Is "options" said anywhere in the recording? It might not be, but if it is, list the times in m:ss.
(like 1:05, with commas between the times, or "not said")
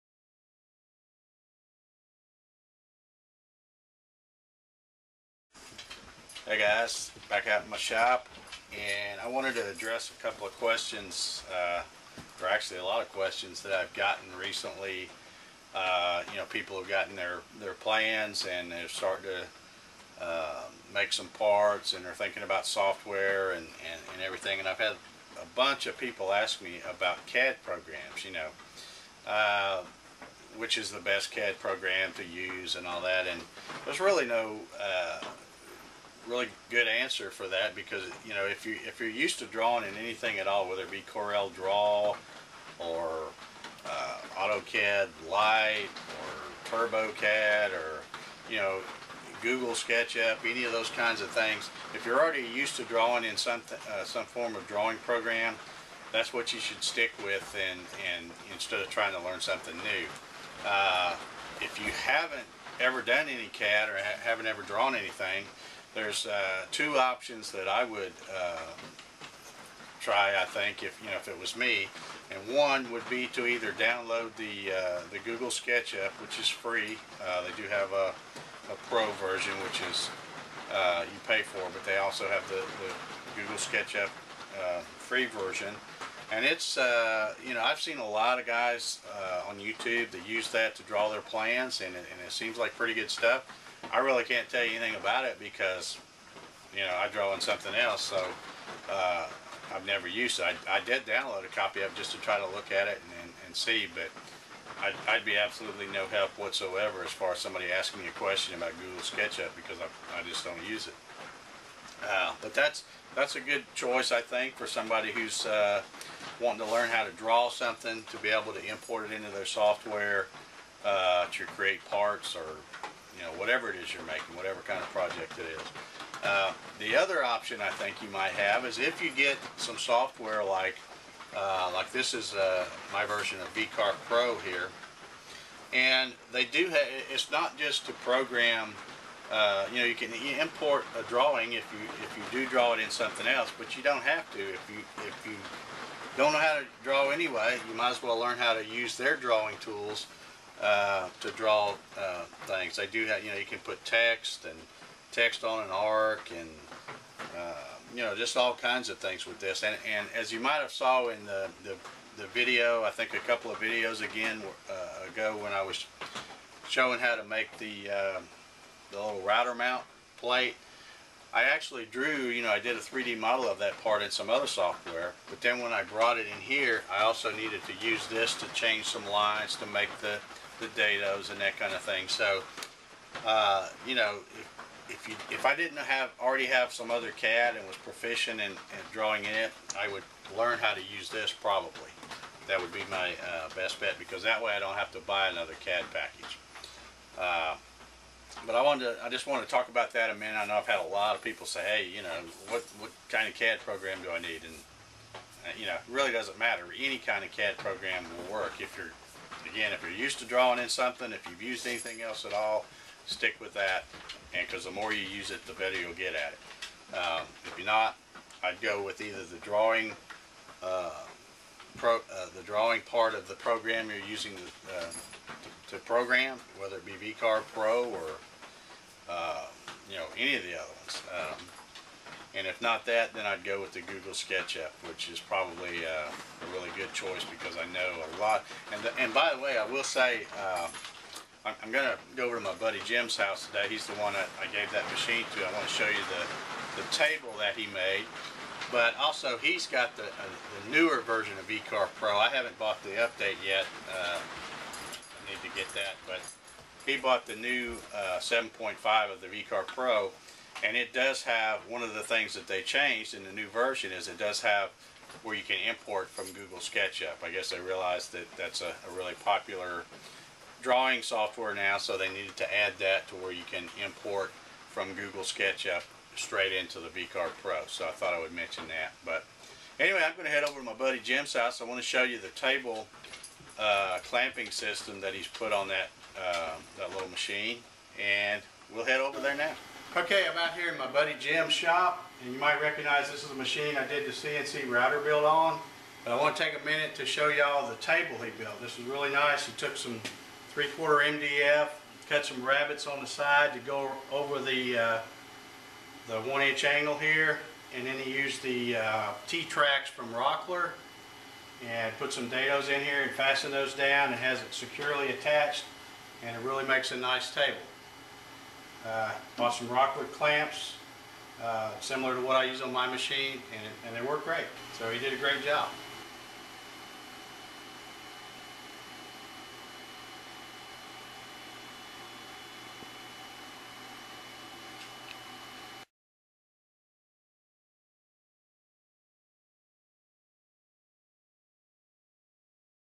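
1:06, 2:07.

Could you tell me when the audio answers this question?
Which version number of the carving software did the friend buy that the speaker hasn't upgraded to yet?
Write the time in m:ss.
4:18.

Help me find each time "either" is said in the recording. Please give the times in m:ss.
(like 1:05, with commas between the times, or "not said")
1:13, 3:39.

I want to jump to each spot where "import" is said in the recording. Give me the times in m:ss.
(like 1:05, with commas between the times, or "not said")
1:58, 2:20, 4:25, 4:33.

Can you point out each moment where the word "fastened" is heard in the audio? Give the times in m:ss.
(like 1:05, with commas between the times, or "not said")
5:13.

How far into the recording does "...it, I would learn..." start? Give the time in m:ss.
3:09.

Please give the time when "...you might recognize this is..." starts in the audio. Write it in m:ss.
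4:52.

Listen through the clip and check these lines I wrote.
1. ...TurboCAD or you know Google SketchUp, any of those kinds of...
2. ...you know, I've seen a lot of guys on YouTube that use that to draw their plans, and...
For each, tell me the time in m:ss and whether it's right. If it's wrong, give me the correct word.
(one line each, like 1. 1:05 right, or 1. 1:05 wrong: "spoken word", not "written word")
1. 0:46 right
2. 1:27 right.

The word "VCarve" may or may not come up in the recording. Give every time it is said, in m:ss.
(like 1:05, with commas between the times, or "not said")
2:13, 3:47, 4:11, 4:19, 4:36.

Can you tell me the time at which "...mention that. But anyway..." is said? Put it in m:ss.
4:38.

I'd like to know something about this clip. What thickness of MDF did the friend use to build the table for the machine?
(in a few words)
three-quarter.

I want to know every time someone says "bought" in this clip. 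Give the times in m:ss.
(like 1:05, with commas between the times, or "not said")
4:12, 4:16, 5:19.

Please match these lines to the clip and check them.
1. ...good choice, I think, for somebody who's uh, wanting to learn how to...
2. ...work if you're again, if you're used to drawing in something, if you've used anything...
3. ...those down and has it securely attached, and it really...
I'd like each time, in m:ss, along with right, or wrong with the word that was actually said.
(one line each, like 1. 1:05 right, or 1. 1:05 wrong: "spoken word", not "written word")
1. 1:53 right
2. 3:28 right
3. 5:13 right.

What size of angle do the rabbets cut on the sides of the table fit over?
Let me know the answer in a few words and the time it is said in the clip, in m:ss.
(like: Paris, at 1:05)
one-inch, at 5:06.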